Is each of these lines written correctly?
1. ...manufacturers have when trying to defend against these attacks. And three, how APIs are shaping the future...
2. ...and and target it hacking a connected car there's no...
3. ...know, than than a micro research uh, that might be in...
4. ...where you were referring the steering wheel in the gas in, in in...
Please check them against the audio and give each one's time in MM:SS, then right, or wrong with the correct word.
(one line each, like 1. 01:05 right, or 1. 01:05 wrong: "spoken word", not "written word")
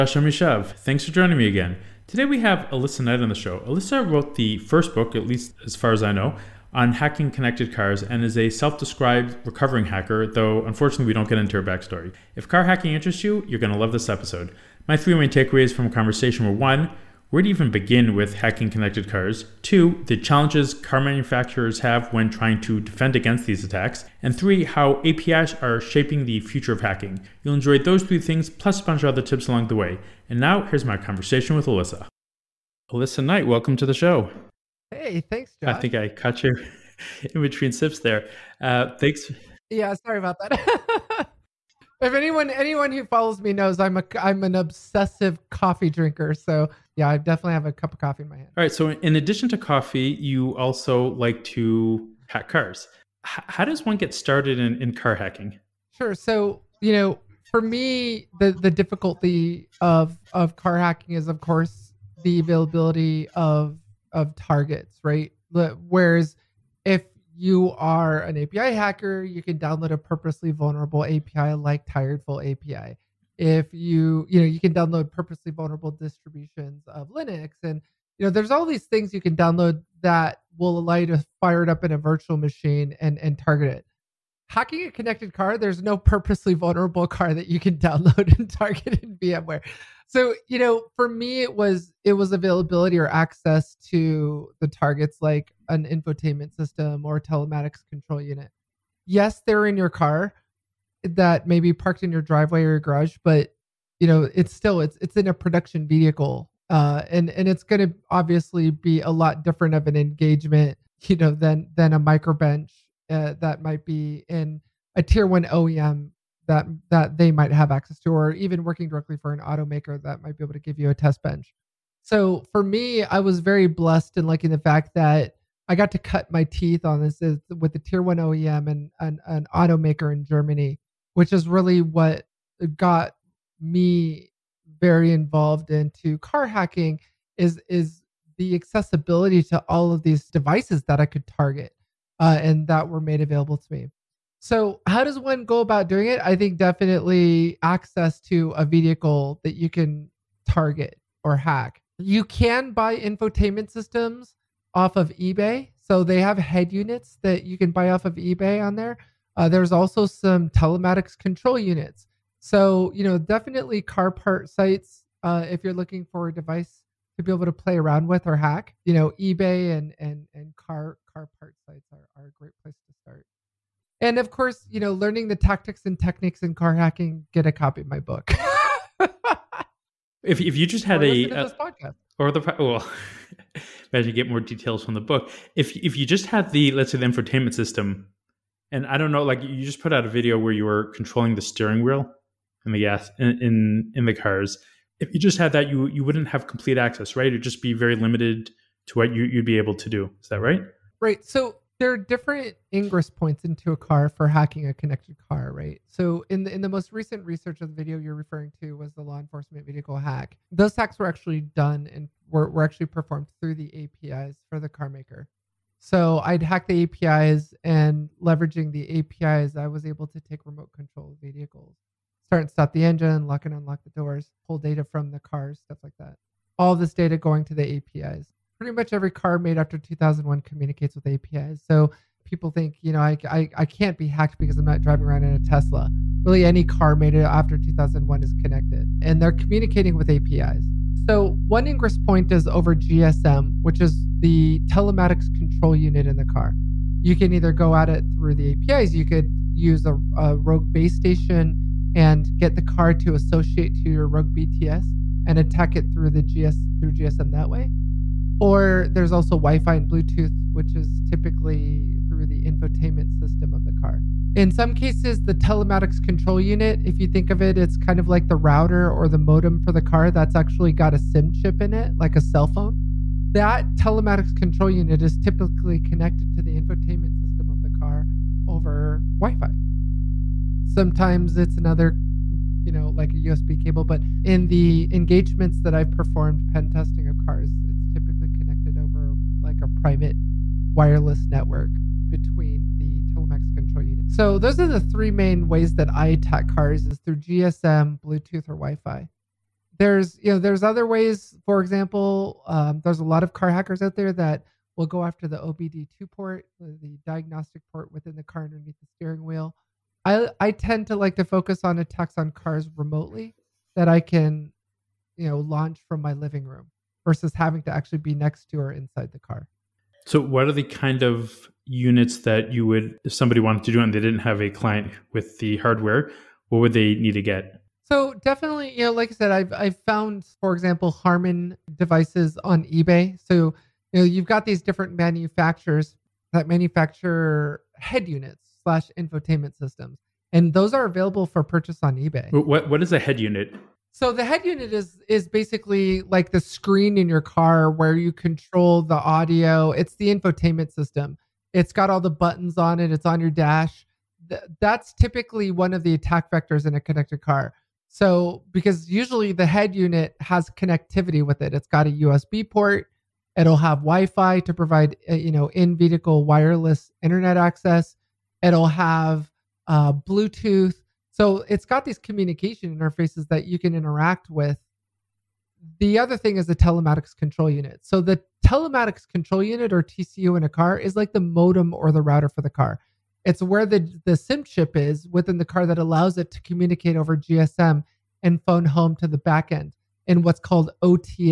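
1. 00:20 right
2. 01:22 right
3. 01:51 wrong: "bench", not "research"
4. 03:10 wrong: "controlling", not "referring".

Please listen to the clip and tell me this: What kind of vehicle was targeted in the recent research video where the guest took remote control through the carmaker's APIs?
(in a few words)
law enforcement vehicle.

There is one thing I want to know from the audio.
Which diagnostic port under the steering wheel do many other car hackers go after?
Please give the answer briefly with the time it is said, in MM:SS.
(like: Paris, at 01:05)
OBD2 port, at 05:05.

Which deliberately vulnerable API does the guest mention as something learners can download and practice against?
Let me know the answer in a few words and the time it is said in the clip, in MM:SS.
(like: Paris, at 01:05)
Tiredful API, at 01:11.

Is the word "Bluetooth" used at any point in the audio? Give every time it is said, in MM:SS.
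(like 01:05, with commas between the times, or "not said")
04:19, 04:58, 06:09.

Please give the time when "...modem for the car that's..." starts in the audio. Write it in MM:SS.
04:29.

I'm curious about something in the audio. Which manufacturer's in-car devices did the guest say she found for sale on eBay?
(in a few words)
Harman.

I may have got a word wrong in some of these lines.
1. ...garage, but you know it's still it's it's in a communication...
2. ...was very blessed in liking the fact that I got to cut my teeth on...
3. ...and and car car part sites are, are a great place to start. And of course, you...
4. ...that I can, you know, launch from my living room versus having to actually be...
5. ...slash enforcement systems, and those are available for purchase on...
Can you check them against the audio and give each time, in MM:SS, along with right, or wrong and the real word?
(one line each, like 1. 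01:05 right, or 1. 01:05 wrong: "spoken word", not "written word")
1. 01:42 wrong: "production", not "communication"
2. 02:03 right
3. 02:49 right
4. 05:13 right
5. 05:38 wrong: "infotainment", not "enforcement".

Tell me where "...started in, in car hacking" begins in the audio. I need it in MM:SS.
00:54.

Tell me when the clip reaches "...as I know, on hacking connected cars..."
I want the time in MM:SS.
00:05.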